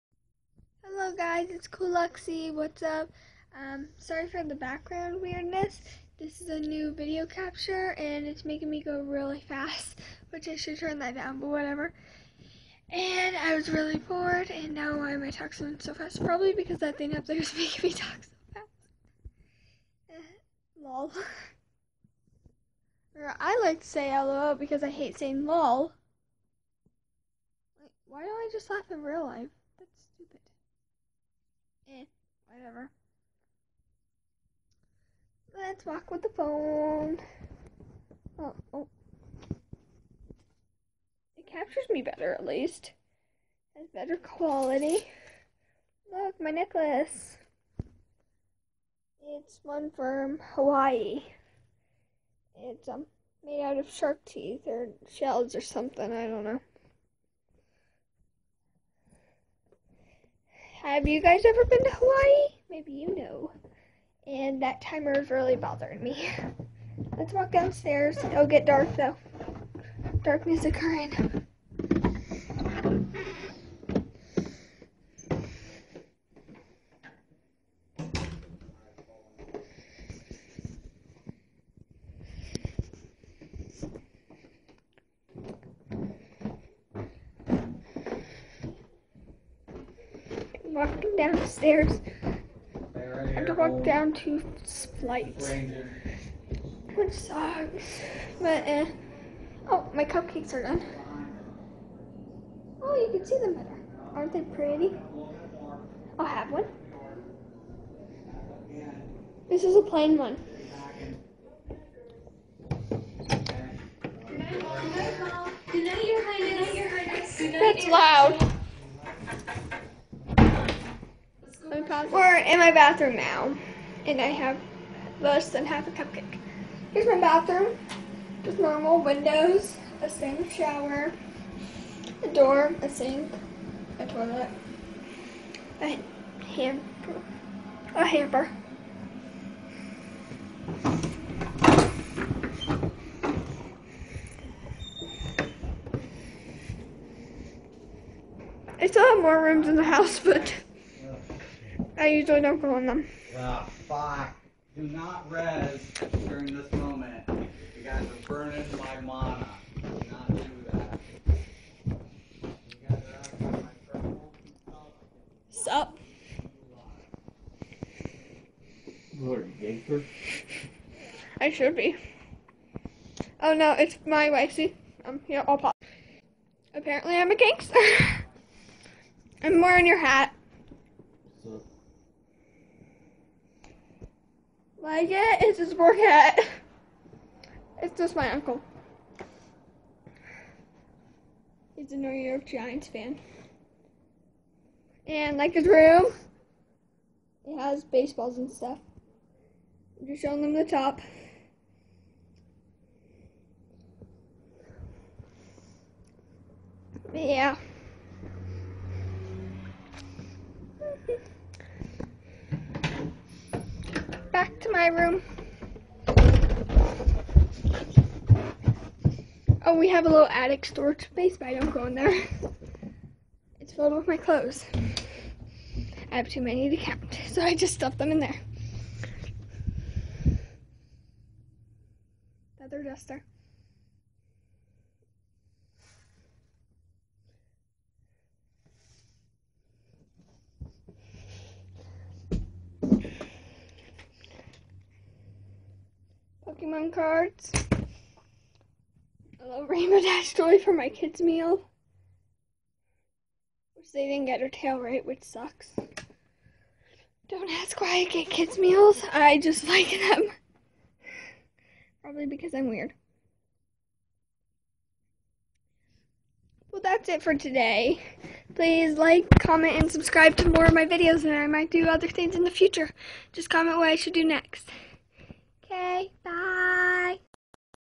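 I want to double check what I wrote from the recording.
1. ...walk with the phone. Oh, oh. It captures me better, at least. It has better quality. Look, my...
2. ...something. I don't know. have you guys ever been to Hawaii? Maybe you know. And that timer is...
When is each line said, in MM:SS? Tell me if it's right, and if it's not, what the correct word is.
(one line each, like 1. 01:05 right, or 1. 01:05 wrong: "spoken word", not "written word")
1. 00:35 right
2. 00:55 right.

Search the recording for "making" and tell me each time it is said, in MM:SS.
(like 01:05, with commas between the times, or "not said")
00:08, 00:17.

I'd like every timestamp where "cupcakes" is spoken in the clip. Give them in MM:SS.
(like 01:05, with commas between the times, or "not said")
01:40, 02:05.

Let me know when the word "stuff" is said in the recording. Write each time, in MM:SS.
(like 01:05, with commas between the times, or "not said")
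03:18, 03:47.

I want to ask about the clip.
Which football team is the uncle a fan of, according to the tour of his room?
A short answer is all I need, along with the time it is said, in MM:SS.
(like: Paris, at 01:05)
New York Giants, at 03:11.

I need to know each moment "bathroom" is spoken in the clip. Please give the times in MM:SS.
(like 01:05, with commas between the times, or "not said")
02:02, 02:07.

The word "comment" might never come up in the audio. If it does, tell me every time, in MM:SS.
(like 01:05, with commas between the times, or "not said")
04:29, 04:33.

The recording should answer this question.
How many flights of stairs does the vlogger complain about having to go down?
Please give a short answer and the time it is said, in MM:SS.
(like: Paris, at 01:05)
2, at 01:34.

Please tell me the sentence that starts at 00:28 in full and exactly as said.
why do I just laugh in real life?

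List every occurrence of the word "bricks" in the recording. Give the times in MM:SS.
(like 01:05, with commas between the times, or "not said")
not said.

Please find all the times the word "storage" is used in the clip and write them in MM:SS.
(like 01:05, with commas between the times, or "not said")
03:40.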